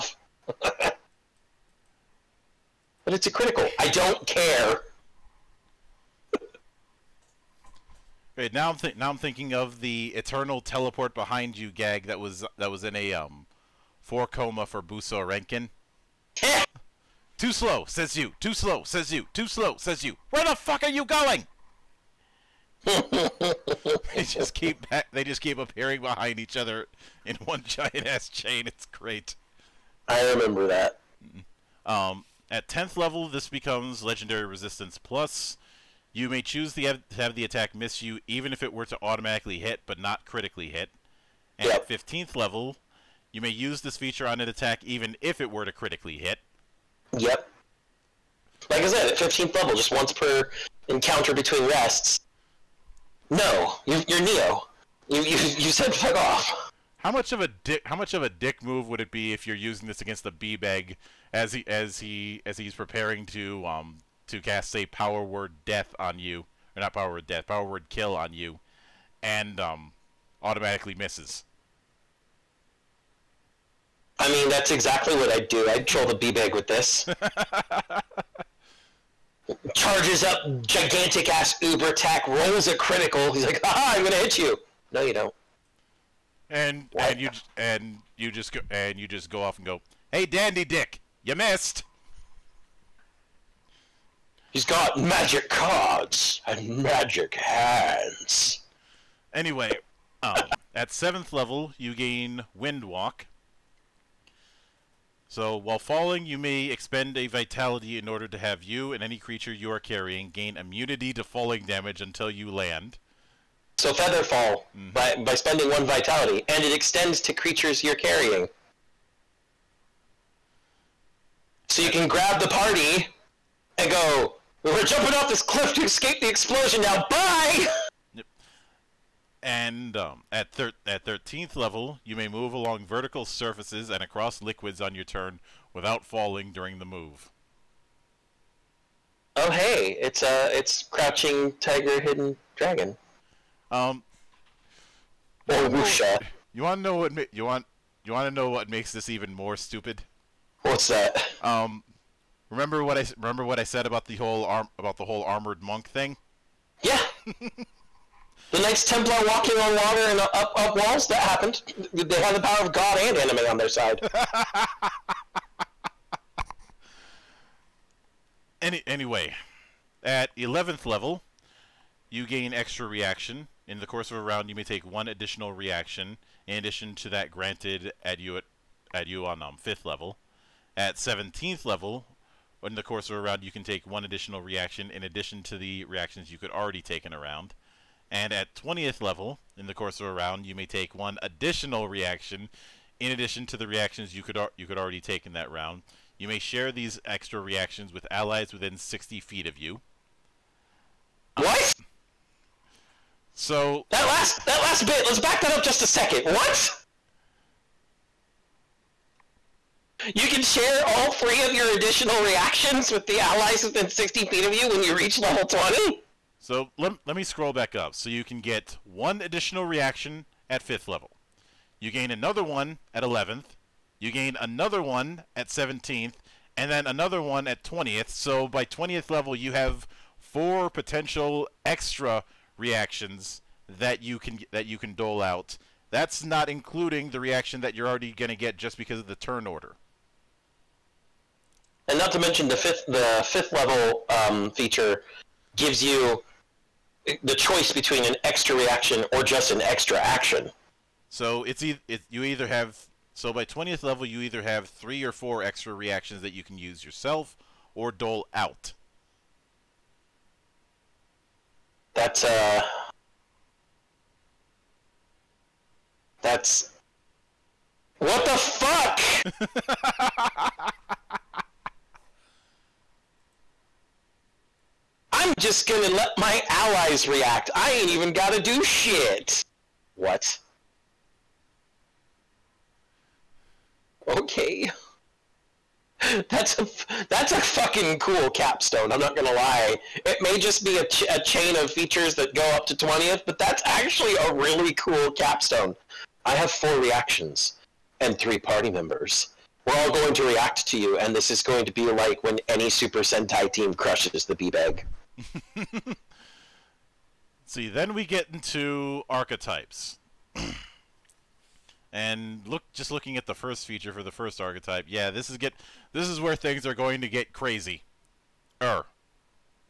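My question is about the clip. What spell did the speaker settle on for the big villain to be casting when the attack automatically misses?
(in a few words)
Power word kill.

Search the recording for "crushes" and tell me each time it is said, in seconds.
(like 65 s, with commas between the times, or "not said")
303 s.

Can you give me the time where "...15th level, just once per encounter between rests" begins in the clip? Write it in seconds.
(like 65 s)
49 s.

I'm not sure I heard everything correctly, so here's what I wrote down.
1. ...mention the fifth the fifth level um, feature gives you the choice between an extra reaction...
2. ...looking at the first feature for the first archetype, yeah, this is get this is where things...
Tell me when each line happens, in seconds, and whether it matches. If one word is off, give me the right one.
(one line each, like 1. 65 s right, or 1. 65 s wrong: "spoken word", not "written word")
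1. 242 s right
2. 312 s right.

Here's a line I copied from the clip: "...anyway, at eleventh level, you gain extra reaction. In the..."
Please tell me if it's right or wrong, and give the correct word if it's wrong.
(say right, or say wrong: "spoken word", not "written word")
right.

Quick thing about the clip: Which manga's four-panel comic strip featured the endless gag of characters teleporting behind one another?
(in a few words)
Buso Renkin.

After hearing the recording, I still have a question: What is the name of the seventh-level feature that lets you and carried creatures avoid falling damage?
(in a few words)
Wind Walk.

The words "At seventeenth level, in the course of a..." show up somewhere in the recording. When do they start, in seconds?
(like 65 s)
180 s.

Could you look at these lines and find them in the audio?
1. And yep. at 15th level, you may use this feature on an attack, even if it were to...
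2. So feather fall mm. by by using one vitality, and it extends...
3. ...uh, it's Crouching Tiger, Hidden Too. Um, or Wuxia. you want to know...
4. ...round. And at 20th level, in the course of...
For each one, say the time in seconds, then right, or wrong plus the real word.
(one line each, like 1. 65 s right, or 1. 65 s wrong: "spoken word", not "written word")
1. 41 s right
2. 113 s wrong: "spending", not "using"
3. 140 s wrong: "Dragon", not "Too"
4. 187 s right.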